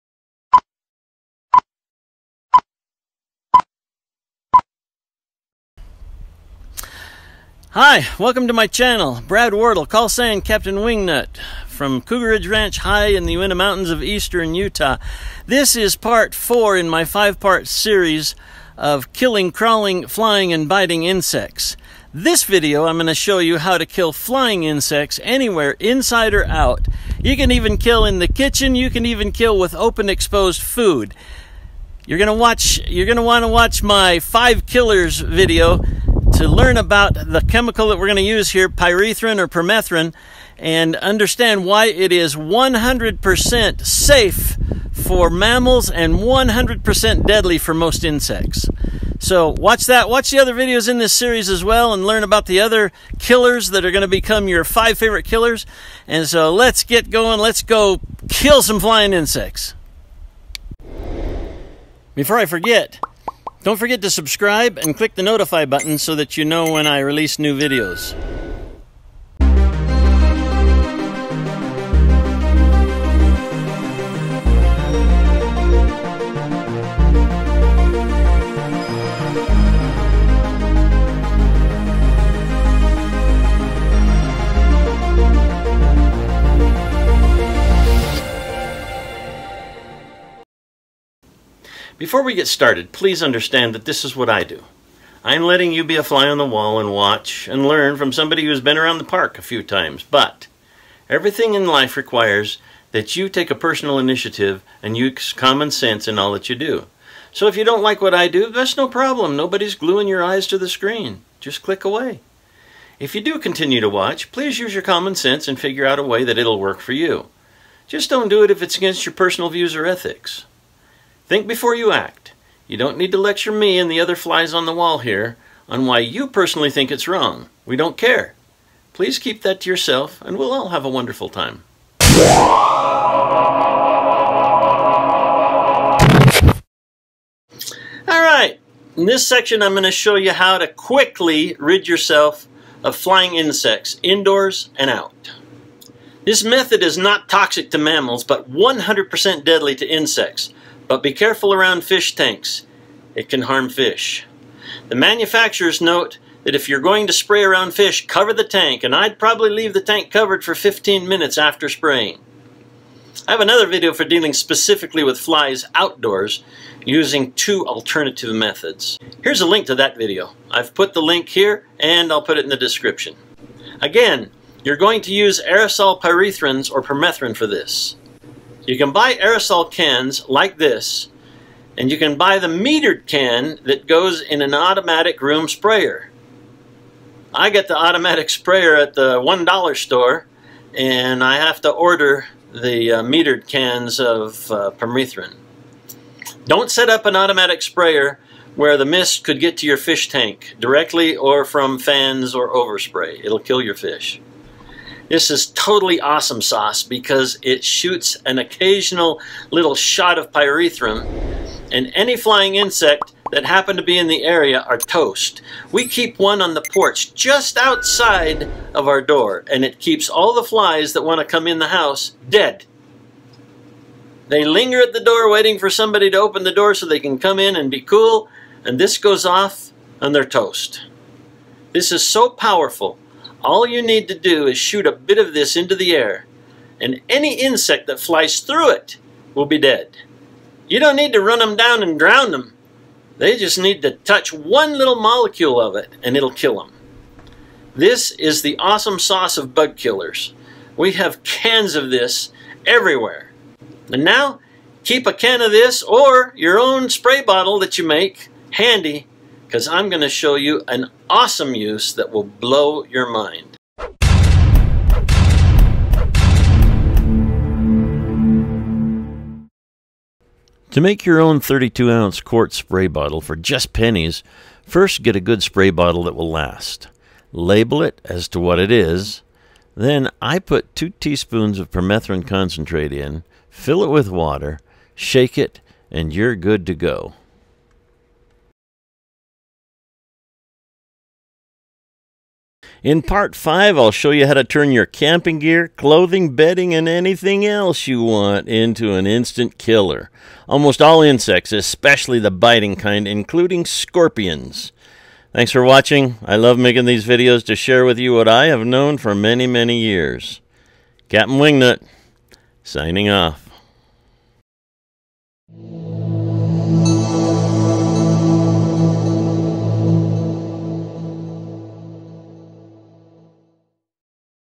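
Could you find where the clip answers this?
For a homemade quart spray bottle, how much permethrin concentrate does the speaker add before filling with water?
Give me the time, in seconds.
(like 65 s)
280 s.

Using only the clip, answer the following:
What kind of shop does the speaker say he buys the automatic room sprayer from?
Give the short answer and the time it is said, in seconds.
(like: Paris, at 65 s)
The $1 store, at 189 s.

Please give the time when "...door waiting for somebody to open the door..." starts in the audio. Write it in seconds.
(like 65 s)
225 s.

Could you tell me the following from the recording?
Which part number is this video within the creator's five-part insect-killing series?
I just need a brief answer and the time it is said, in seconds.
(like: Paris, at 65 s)
Part 4, at 15 s.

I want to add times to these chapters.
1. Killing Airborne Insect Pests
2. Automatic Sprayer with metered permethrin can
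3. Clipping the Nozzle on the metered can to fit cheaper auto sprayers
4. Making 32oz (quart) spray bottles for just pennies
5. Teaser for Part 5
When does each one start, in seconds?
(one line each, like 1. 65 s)
1. 124 s
2. 183 s
3. 218 s
4. 269 s
5. 292 s.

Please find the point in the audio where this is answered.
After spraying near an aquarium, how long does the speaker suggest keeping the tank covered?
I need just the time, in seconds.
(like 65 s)
160 s.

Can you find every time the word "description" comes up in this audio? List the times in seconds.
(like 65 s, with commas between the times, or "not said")
172 s.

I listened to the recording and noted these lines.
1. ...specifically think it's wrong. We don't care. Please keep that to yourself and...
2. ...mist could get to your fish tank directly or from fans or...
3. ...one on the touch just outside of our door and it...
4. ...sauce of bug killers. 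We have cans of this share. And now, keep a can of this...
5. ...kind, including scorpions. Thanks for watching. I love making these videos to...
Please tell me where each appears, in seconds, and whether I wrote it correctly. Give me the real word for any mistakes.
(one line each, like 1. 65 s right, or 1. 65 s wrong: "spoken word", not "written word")
1. 126 s wrong: "personally", not "specifically"
2. 198 s right
3. 216 s wrong: "porch", not "touch"
4. 248 s wrong: "everywhere", not "share"
5. 302 s right.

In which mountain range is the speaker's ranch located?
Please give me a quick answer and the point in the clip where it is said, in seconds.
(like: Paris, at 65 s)
Uinta Mountains, at 13 s.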